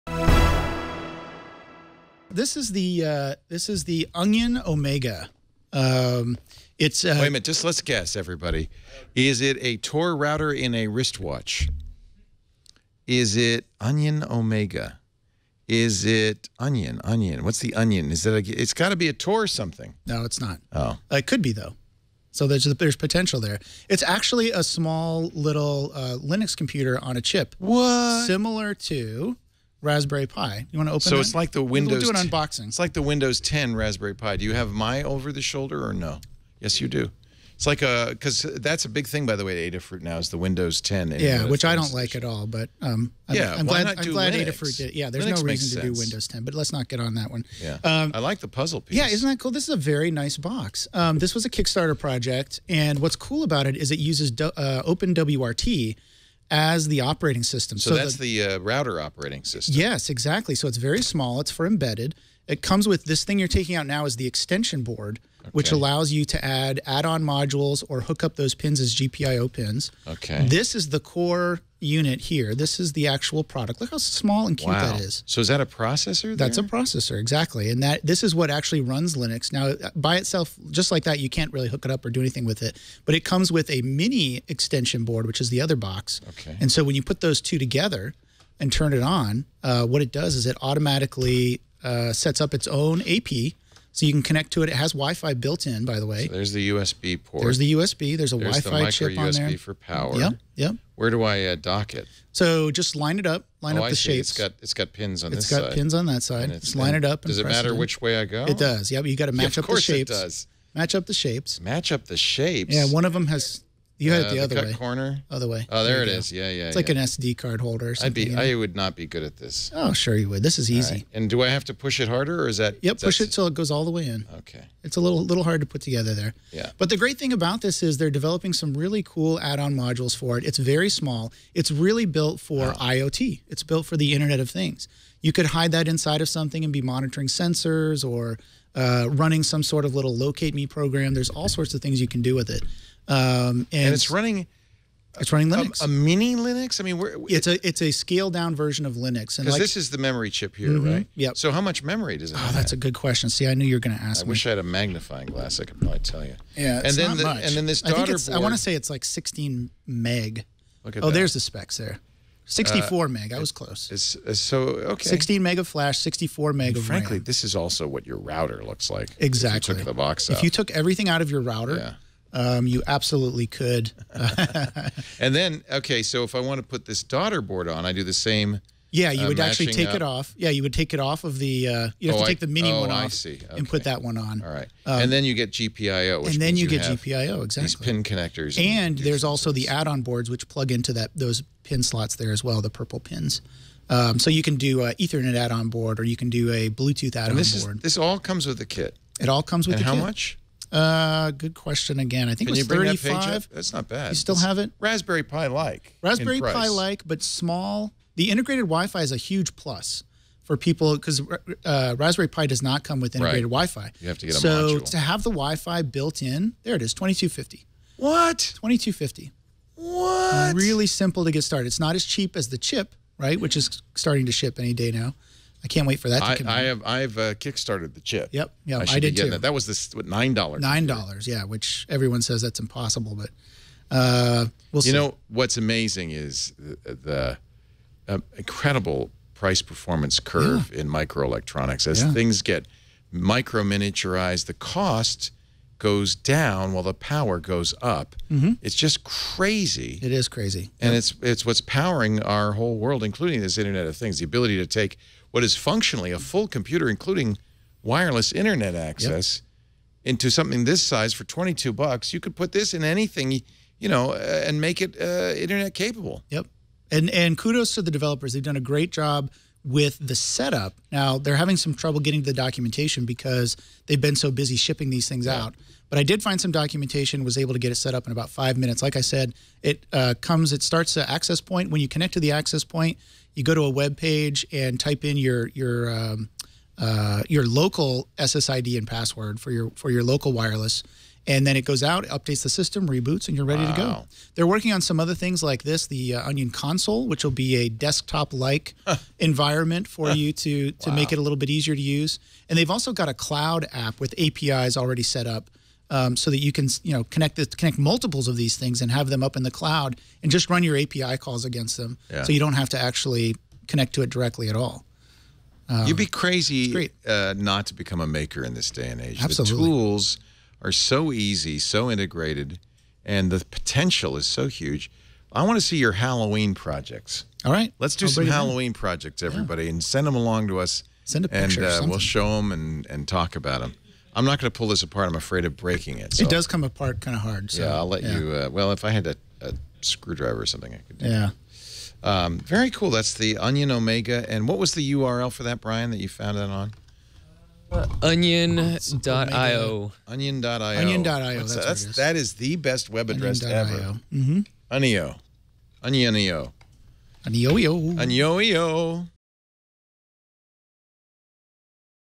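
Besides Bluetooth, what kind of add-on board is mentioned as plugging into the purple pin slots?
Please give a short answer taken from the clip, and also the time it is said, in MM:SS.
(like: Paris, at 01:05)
Ethernet, at 03:14.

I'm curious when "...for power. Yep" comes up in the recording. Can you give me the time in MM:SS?
01:39.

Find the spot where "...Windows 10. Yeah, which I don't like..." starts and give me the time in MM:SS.
00:40.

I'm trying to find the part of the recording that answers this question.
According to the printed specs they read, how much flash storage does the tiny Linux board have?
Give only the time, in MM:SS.
02:45.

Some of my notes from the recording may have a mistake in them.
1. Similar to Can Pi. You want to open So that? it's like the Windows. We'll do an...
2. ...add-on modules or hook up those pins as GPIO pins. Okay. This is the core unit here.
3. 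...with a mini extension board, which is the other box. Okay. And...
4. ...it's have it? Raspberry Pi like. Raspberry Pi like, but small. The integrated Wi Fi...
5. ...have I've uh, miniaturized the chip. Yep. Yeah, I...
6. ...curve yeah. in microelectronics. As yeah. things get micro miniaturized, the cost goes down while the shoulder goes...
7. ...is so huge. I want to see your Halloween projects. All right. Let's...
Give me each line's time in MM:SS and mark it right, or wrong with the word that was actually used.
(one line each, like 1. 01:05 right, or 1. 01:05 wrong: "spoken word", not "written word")
1. 00:28 wrong: "Raspberry", not "Can"
2. 01:06 right
3. 01:23 right
4. 03:24 right
5. 03:46 wrong: "kickstarted", not "miniaturized"
6. 04:00 wrong: "power", not "shoulder"
7. 05:24 right.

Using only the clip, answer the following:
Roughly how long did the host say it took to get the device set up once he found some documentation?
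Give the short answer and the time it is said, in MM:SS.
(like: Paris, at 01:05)
About five minutes, at 04:38.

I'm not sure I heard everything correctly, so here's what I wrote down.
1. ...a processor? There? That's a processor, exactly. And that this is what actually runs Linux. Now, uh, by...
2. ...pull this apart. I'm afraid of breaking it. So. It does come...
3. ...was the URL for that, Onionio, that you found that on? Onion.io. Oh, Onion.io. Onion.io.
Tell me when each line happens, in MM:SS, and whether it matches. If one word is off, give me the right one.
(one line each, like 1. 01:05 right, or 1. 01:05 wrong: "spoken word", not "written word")
1. 01:15 right
2. 05:34 right
3. 05:44 wrong: "Brian", not "Onionio".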